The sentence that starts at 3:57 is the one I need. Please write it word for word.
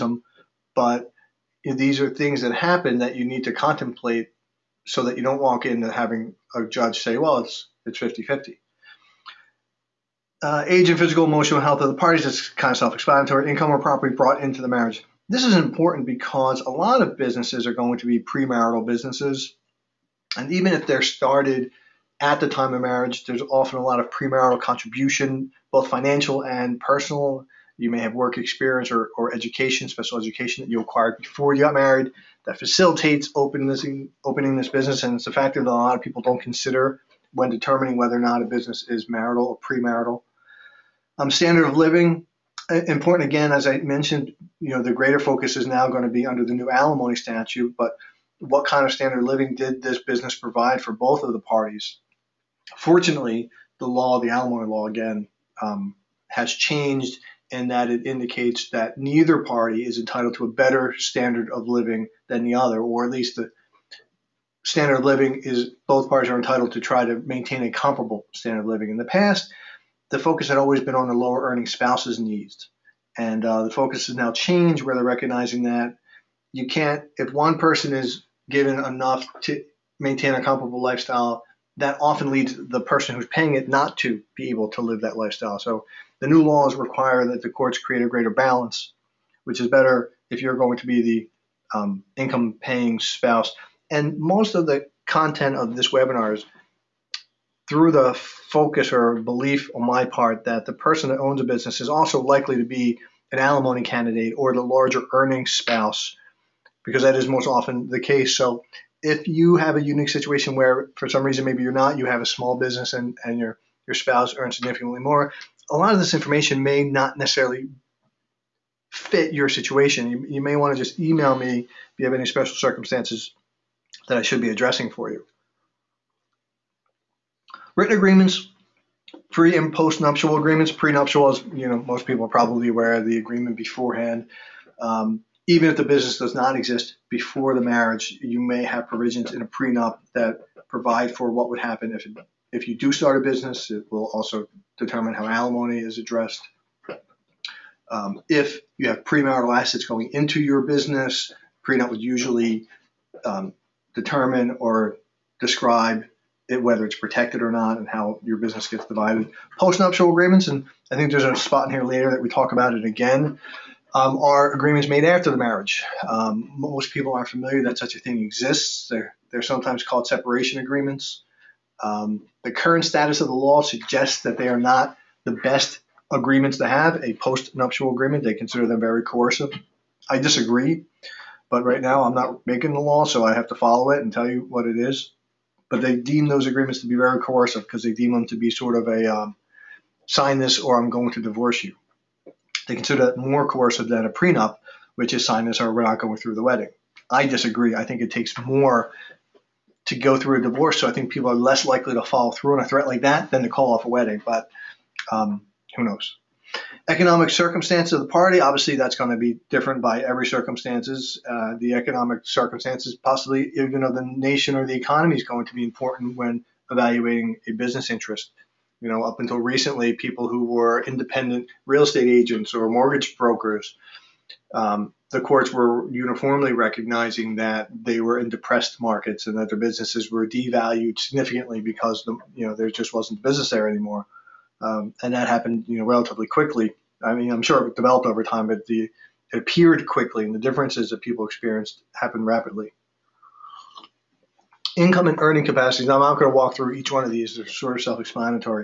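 I mean, I'm sure it developed over time, but the it appeared quickly, and the differences that people experienced happened rapidly.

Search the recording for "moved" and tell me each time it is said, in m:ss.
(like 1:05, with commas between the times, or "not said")
not said.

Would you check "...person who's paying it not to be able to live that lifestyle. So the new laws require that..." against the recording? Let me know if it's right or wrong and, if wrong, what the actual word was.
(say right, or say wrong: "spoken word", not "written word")
right.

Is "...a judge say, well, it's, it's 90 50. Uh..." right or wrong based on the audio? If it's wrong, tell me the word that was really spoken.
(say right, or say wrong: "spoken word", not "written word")
wrong: "50", not "90".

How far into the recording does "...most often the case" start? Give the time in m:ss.
1:47.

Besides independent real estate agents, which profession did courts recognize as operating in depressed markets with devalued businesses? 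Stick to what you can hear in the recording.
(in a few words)
mortgage brokers.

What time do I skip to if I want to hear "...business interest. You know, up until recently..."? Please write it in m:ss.
3:37.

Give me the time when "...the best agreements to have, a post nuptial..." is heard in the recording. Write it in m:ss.
2:55.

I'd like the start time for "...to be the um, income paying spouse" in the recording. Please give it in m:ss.
1:30.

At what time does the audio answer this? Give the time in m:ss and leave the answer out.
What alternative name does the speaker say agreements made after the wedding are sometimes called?
2:50.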